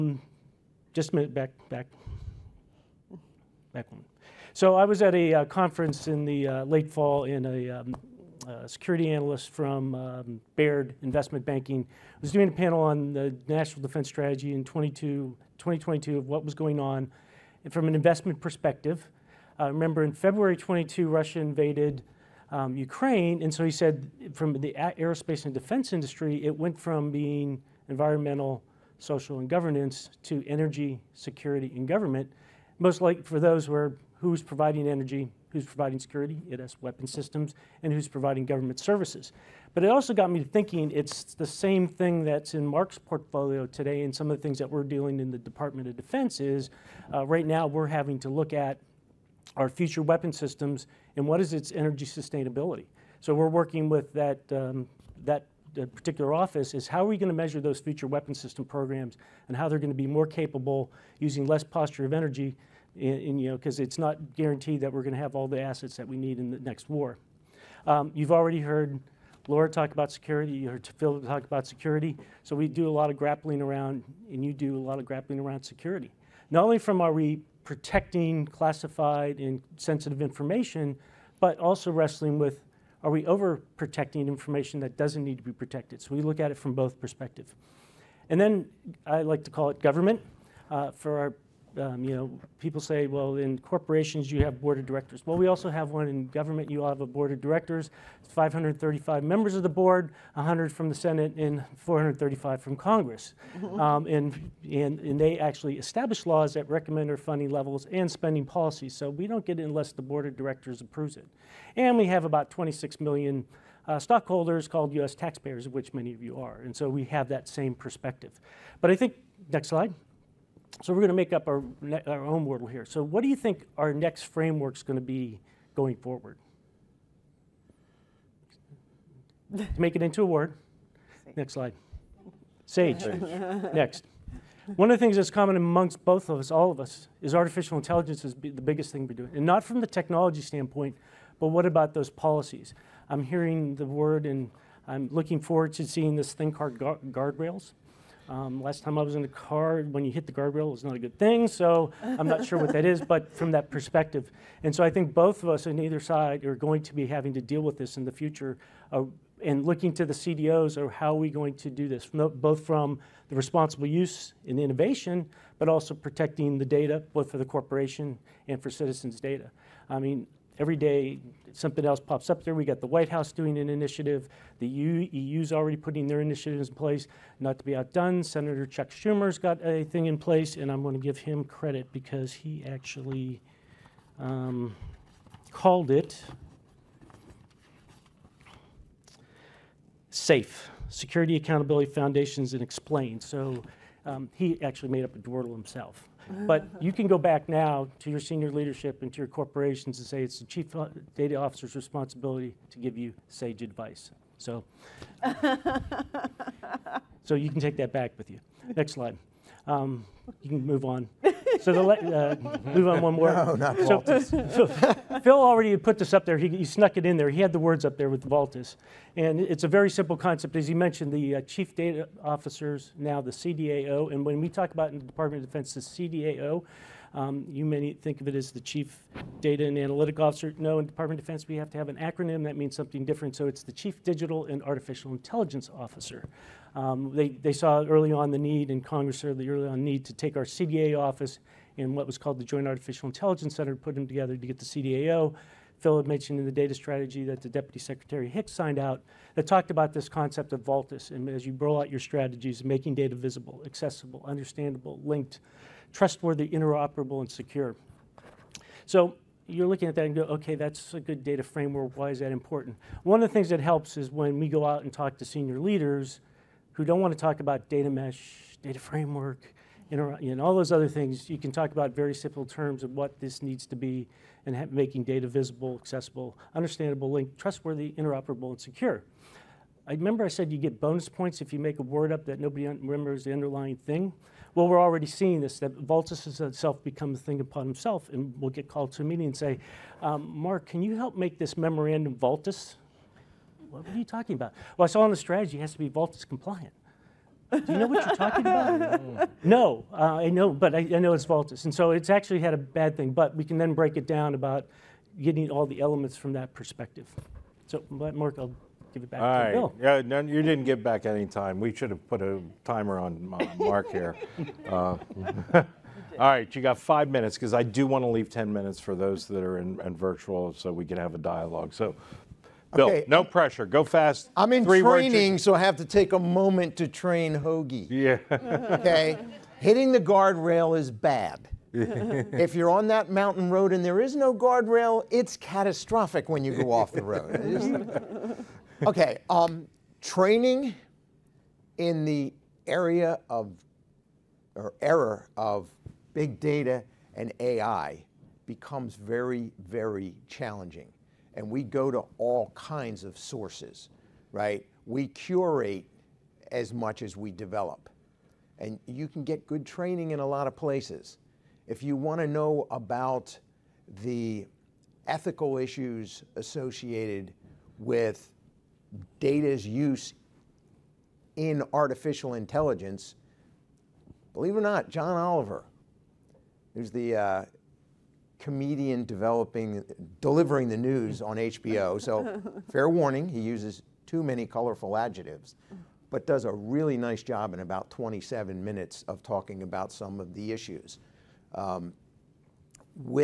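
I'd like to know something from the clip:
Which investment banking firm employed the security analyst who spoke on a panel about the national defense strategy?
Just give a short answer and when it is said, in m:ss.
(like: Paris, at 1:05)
Baird, at 0:10.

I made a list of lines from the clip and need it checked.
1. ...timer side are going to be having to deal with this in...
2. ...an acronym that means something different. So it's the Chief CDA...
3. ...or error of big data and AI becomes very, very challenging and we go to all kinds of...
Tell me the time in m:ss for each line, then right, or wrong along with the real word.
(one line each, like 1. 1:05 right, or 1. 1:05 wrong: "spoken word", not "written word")
1. 2:35 wrong: "either", not "timer"
2. 3:51 wrong: "Digital", not "CDA"
3. 5:44 right.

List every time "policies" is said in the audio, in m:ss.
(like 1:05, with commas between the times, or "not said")
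1:48, 2:22.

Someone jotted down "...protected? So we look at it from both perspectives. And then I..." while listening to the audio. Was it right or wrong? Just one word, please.
right.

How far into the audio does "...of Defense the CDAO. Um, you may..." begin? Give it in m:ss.
3:45.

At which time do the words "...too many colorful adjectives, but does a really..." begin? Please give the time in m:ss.
6:24.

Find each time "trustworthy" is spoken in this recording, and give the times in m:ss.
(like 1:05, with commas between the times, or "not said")
4:15, 4:37.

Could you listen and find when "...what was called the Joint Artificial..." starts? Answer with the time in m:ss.
4:01.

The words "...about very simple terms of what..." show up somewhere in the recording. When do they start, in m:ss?
4:31.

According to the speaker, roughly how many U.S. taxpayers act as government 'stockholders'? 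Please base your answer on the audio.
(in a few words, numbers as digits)
26 million.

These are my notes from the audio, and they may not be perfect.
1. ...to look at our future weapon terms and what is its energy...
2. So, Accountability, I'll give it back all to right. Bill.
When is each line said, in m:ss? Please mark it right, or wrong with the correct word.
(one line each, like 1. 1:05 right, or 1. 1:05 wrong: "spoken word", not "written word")
1. 0:48 wrong: "systems", not "terms"
2. 5:07 wrong: "Mark", not "Accountability".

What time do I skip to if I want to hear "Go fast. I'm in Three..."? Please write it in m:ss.
5:23.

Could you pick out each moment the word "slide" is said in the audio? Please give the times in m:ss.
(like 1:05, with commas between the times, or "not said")
1:59, 2:11, 3:28.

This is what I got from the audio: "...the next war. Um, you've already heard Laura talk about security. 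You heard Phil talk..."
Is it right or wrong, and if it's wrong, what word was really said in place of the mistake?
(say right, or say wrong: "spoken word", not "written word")
right.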